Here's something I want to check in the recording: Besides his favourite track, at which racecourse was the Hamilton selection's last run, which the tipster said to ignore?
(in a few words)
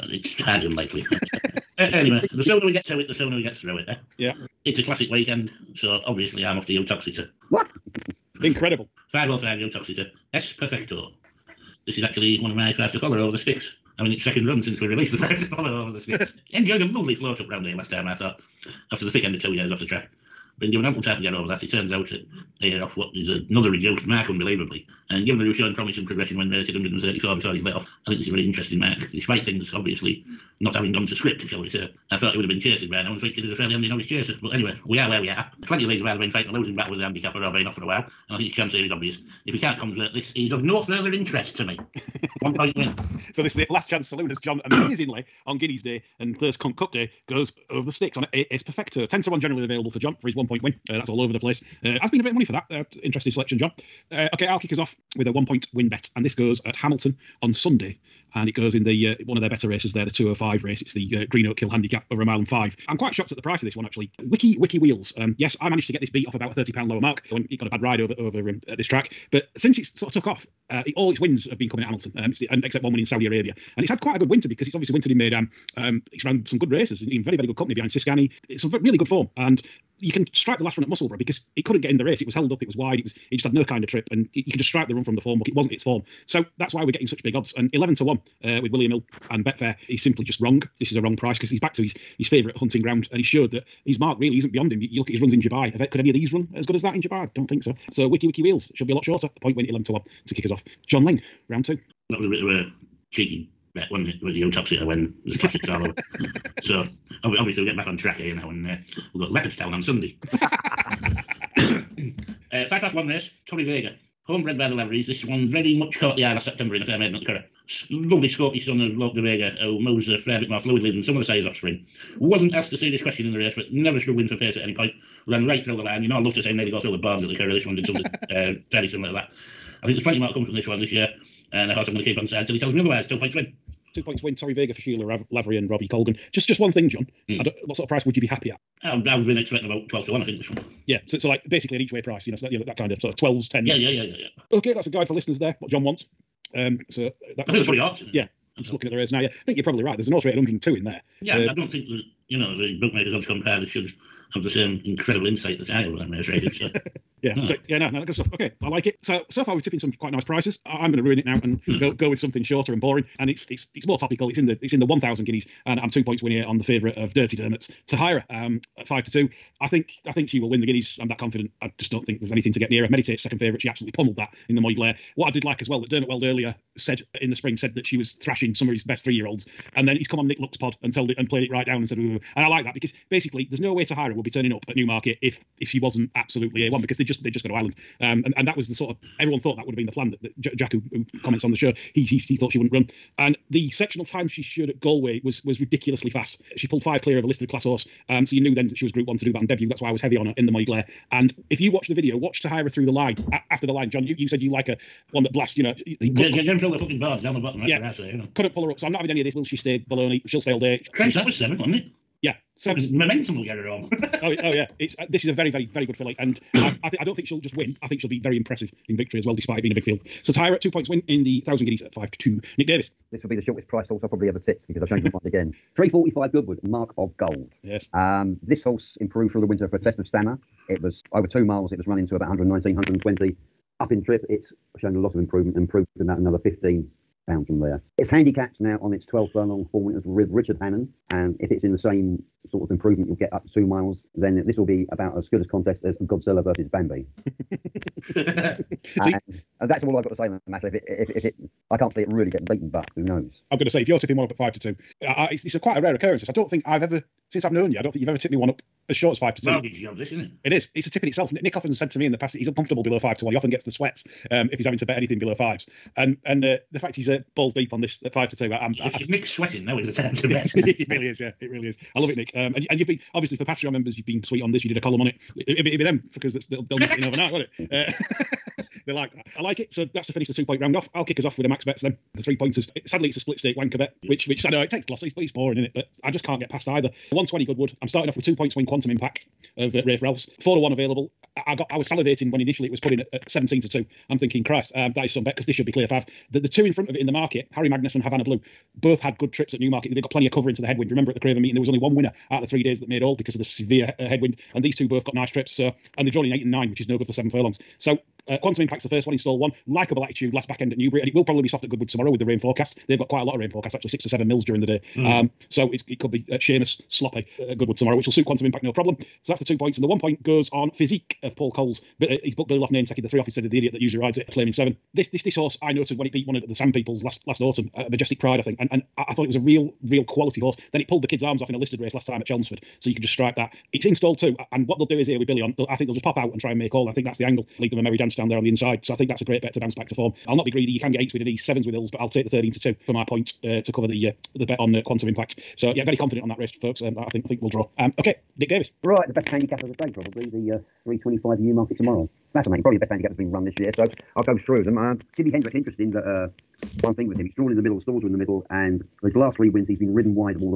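Musselburgh.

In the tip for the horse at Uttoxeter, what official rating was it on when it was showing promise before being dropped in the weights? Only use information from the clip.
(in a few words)
134.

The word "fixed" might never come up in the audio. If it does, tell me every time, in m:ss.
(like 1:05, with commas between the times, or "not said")
not said.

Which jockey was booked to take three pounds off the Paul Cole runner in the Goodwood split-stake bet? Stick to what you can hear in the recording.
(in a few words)
Billy Loughnane.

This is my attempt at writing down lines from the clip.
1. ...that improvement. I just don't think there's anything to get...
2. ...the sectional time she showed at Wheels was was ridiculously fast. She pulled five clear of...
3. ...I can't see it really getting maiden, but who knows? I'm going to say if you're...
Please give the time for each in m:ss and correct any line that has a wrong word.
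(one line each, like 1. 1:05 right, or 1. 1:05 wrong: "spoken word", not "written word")
1. 2:51 wrong: "confident", not "improvement"
2. 3:13 wrong: "Galway", not "Wheels"
3. 4:11 wrong: "beaten", not "maiden".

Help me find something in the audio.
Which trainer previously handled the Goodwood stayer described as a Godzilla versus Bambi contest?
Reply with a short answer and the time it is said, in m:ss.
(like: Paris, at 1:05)
Richard Hannon, at 4:00.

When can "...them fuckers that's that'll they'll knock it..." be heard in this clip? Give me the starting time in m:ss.
4:35.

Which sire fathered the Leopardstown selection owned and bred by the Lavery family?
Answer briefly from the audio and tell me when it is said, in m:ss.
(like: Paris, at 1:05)
Lope de Vega, at 1:58.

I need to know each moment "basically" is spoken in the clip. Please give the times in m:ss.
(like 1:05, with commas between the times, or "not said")
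2:21, 3:03.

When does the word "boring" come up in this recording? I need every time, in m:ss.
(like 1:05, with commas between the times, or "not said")
2:42, 4:45.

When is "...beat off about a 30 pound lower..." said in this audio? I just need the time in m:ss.
1:06.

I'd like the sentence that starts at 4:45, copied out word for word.
But I just can't get past either.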